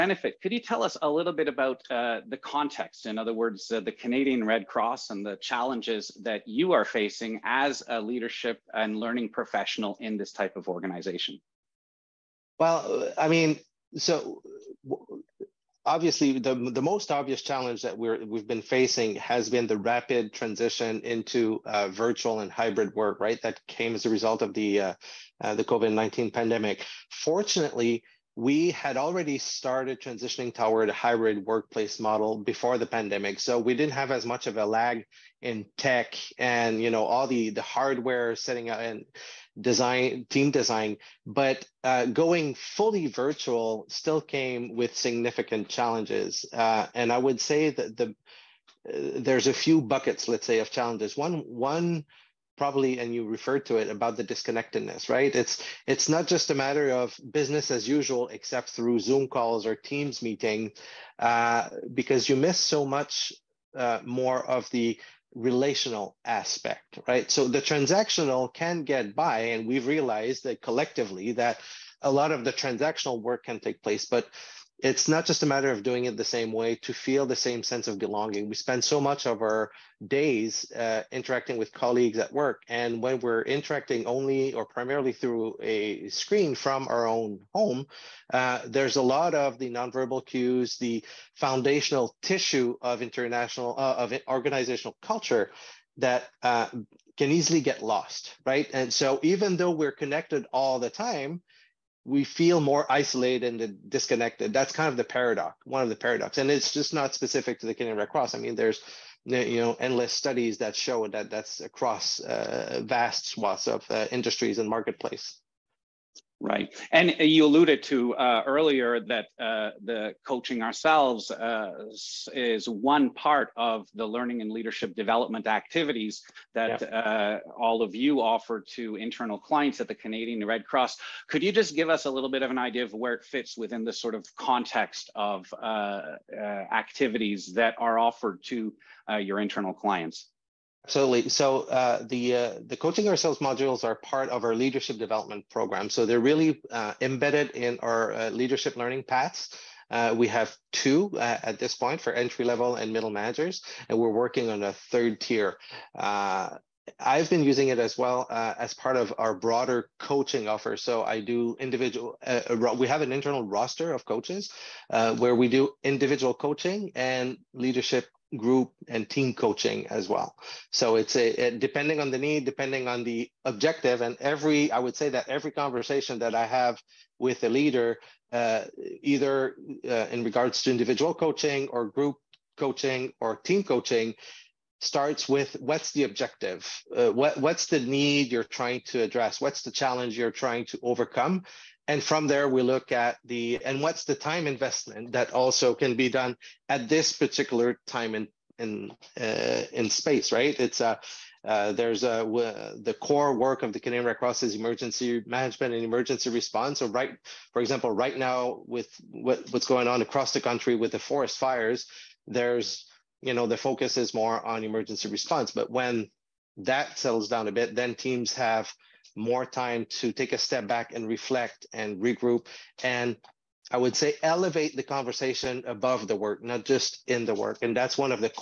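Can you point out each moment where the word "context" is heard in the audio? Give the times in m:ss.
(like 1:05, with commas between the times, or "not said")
0:02, 2:14.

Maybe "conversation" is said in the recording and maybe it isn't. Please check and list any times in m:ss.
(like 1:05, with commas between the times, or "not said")
2:55, 3:44.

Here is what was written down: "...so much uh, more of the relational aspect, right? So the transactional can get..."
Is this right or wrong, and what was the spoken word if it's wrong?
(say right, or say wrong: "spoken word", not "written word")
right.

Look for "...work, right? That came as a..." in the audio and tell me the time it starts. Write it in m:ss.
0:22.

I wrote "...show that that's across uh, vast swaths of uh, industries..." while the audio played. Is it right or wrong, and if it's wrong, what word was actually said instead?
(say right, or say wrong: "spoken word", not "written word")
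right.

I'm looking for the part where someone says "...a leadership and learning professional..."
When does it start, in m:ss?
0:07.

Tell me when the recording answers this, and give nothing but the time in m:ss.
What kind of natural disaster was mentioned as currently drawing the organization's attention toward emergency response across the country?
3:30.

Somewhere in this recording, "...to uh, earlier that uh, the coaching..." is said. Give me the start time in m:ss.
1:57.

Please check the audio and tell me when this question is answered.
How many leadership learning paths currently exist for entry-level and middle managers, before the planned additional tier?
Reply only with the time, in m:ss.
2:30.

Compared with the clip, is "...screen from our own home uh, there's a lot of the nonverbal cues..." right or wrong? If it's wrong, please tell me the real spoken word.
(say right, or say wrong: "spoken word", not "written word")
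right.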